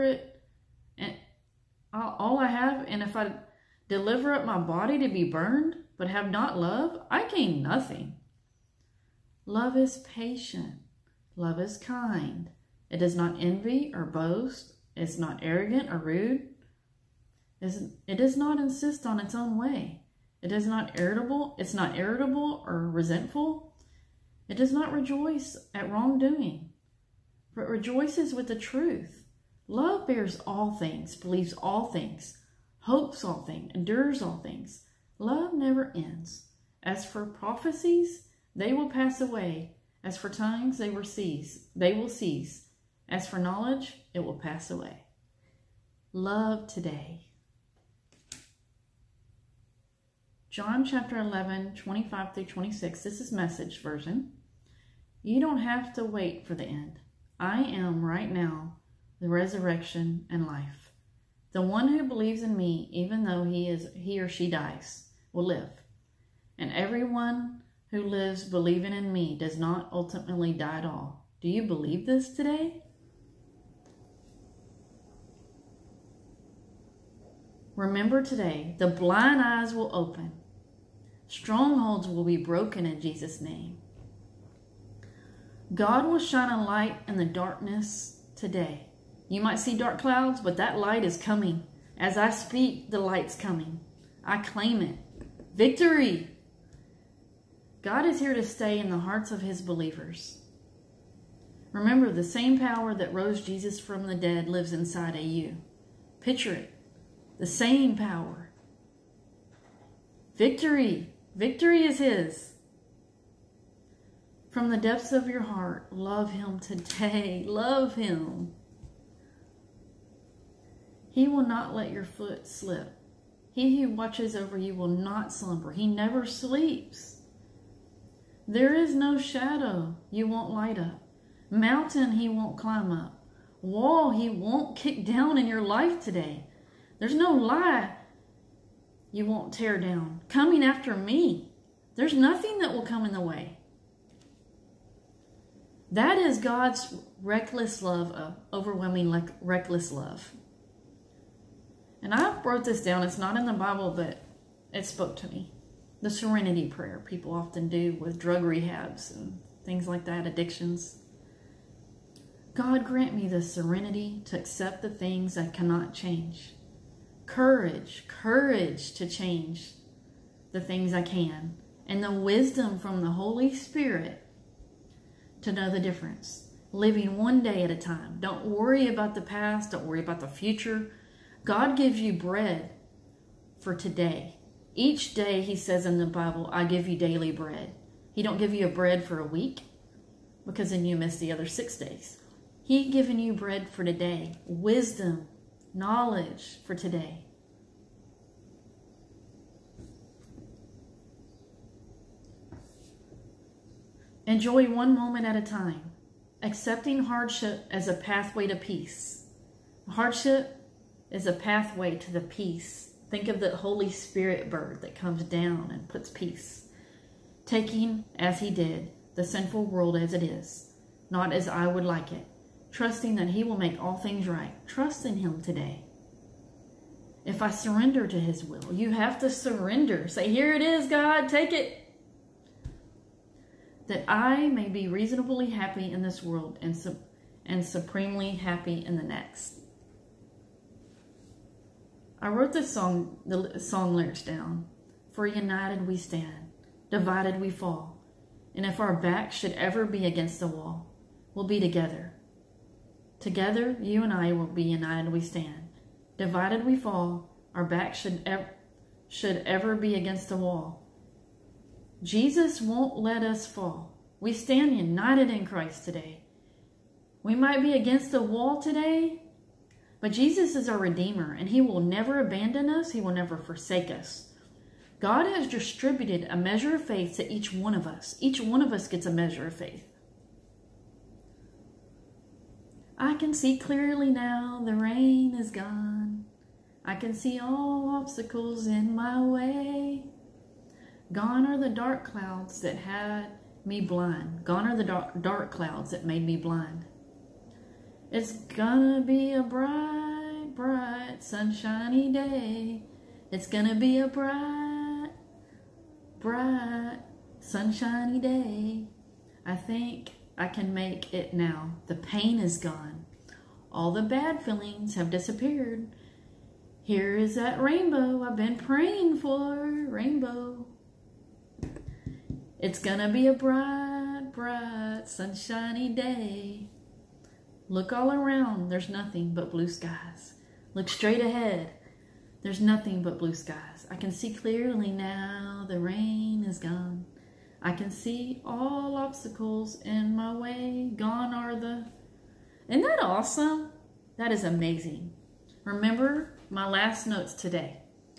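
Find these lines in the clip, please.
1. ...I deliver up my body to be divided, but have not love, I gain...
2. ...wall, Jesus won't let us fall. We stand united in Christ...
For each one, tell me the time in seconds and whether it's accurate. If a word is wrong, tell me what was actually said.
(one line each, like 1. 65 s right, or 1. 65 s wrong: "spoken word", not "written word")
1. 3 s wrong: "burned", not "divided"
2. 260 s right.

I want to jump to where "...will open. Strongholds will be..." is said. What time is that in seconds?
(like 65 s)
79 s.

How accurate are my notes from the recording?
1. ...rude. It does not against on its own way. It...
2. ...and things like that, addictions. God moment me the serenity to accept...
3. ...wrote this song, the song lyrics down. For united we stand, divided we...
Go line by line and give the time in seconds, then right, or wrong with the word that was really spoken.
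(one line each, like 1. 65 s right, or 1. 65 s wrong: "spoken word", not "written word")
1. 15 s wrong: "insist", not "against"
2. 159 s wrong: "grant", not "moment"
3. 242 s right.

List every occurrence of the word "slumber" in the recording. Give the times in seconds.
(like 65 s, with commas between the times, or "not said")
125 s.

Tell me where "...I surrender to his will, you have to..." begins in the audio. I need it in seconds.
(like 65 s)
227 s.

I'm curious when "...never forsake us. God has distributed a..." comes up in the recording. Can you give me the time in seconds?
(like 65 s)
273 s.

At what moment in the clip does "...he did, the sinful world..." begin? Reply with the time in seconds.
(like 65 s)
218 s.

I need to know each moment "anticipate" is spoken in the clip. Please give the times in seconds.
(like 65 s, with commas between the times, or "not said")
not said.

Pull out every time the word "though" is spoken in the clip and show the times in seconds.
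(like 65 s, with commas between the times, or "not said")
63 s.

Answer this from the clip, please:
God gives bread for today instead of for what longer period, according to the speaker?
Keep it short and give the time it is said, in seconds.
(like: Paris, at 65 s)
a week, at 189 s.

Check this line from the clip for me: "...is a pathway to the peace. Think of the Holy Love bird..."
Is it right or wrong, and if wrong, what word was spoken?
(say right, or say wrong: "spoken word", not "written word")
wrong: "Spirit", not "Love".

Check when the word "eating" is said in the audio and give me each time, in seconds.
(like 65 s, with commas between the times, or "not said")
not said.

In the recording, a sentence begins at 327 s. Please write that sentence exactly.
Look all around, there's nothing but blue skies.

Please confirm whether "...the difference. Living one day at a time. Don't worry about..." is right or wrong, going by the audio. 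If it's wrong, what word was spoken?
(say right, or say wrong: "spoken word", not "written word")
right.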